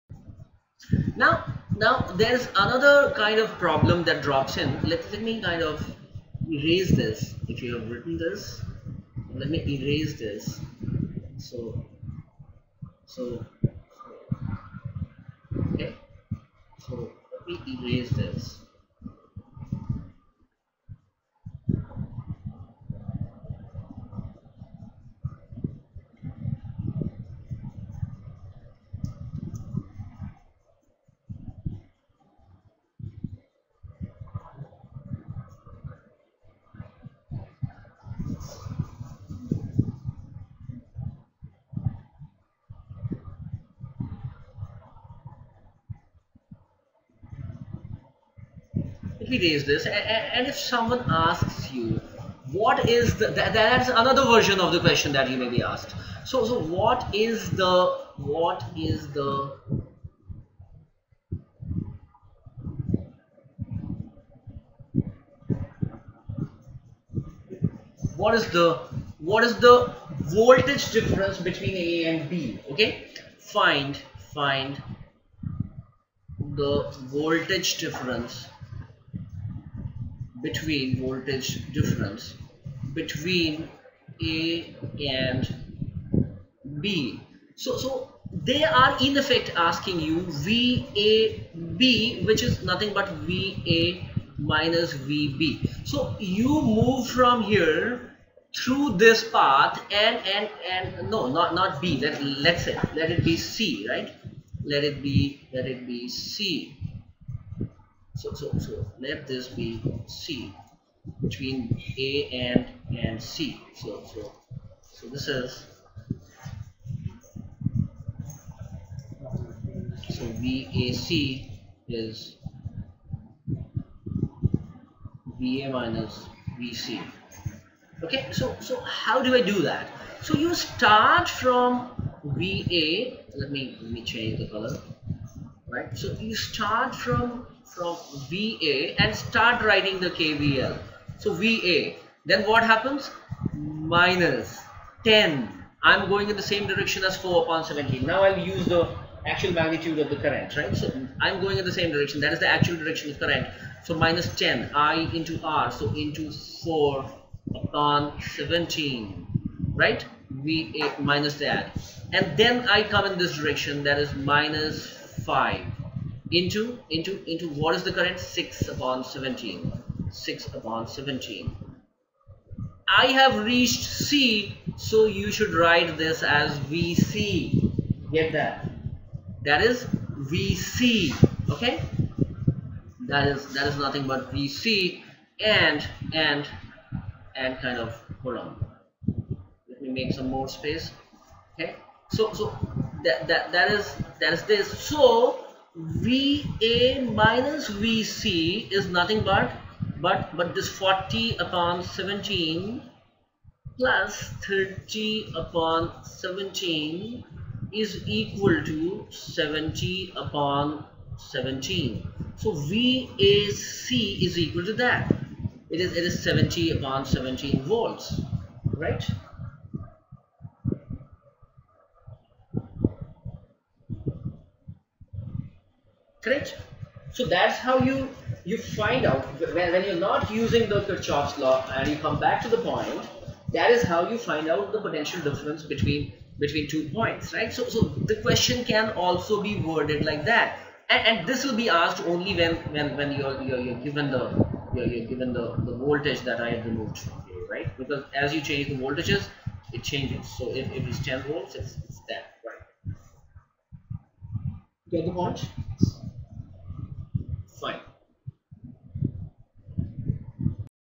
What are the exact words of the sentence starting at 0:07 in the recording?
If you have written this, let me erase this.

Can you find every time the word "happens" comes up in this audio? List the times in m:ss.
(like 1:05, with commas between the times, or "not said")
2:22.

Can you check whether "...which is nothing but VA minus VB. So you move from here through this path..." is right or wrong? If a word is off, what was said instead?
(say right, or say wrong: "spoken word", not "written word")
right.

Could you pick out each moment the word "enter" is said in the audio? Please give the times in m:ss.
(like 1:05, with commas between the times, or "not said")
not said.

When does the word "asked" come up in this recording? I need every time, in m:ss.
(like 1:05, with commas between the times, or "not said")
0:55, 4:01.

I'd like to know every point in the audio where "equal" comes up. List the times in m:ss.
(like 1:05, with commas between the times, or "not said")
3:28, 3:34.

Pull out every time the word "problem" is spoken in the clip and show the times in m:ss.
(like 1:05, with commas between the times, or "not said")
0:03.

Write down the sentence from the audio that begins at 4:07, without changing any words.
Because as you change the voltages, it changes.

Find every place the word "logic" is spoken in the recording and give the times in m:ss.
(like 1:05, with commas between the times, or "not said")
not said.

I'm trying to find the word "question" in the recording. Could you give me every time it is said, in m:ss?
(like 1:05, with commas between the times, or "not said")
0:54, 3:58.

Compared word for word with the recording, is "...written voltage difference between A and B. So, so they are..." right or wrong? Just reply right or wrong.
wrong.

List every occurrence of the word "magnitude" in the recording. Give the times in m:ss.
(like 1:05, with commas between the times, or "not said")
2:29.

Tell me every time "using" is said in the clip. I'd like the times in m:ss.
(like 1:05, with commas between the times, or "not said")
3:50.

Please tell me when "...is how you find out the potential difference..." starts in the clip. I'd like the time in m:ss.
3:53.